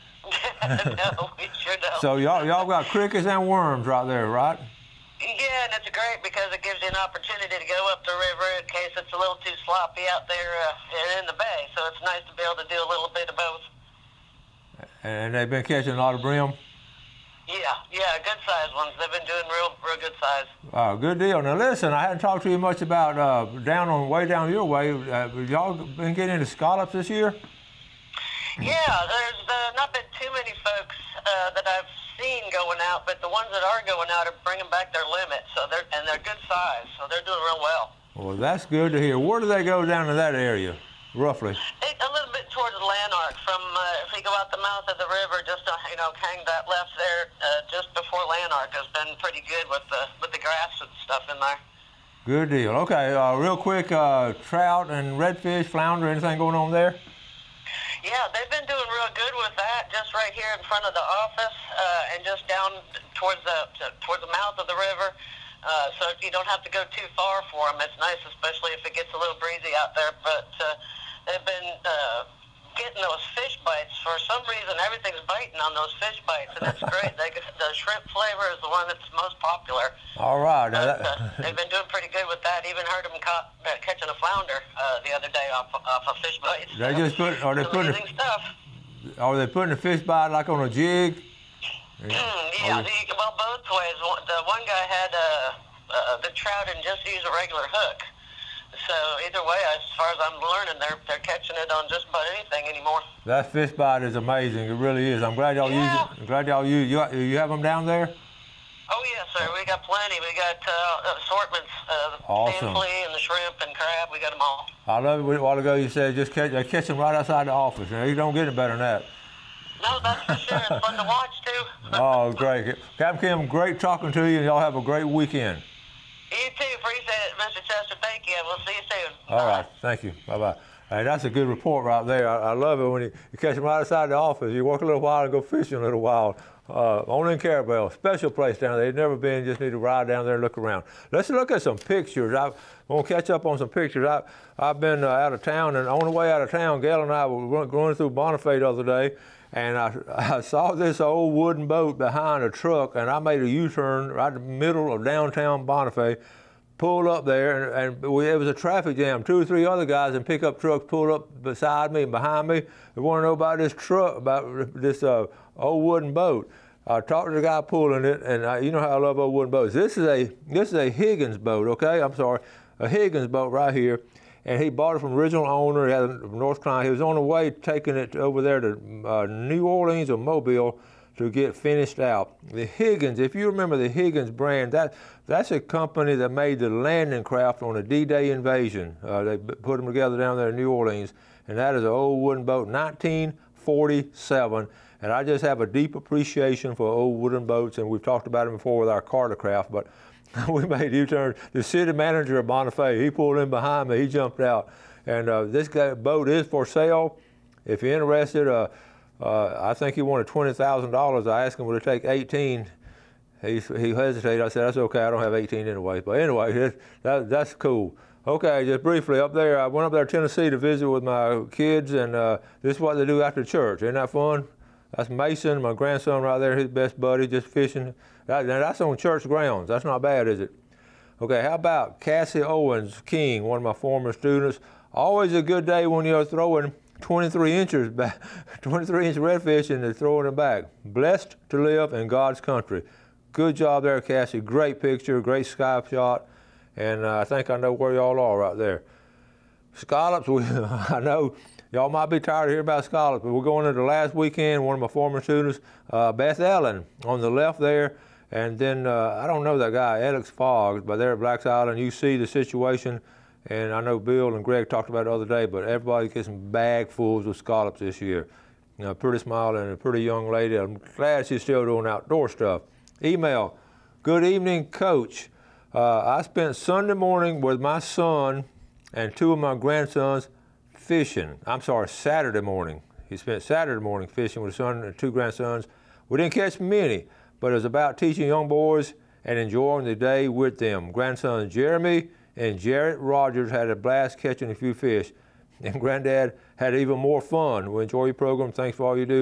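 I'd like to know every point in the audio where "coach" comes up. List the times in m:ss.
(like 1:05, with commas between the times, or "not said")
4:34.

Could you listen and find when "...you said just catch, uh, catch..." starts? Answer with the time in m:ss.
1:55.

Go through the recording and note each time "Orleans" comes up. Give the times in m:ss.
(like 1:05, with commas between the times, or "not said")
2:59, 3:10.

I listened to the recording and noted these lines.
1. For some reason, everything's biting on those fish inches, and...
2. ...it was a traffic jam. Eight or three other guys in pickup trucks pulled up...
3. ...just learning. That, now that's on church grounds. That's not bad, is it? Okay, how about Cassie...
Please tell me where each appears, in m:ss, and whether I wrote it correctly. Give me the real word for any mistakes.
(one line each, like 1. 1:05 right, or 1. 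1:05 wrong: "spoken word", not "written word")
1. 1:14 wrong: "bites", not "inches"
2. 2:38 wrong: "Two", not "Eight"
3. 3:47 wrong: "fishing", not "learning".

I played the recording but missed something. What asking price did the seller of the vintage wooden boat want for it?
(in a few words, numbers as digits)
$20,000.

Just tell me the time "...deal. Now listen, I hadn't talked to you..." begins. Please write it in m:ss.
0:21.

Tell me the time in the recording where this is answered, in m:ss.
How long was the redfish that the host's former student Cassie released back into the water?
3:58.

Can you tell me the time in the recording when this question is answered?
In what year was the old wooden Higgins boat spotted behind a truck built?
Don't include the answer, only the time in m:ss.
3:12.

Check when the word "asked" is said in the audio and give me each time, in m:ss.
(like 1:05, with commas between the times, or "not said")
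3:31.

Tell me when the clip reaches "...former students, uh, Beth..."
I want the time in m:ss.
4:14.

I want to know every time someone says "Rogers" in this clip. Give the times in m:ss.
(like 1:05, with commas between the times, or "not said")
4:52.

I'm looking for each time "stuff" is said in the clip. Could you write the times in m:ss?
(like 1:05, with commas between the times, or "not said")
0:51, 1:28, 4:32.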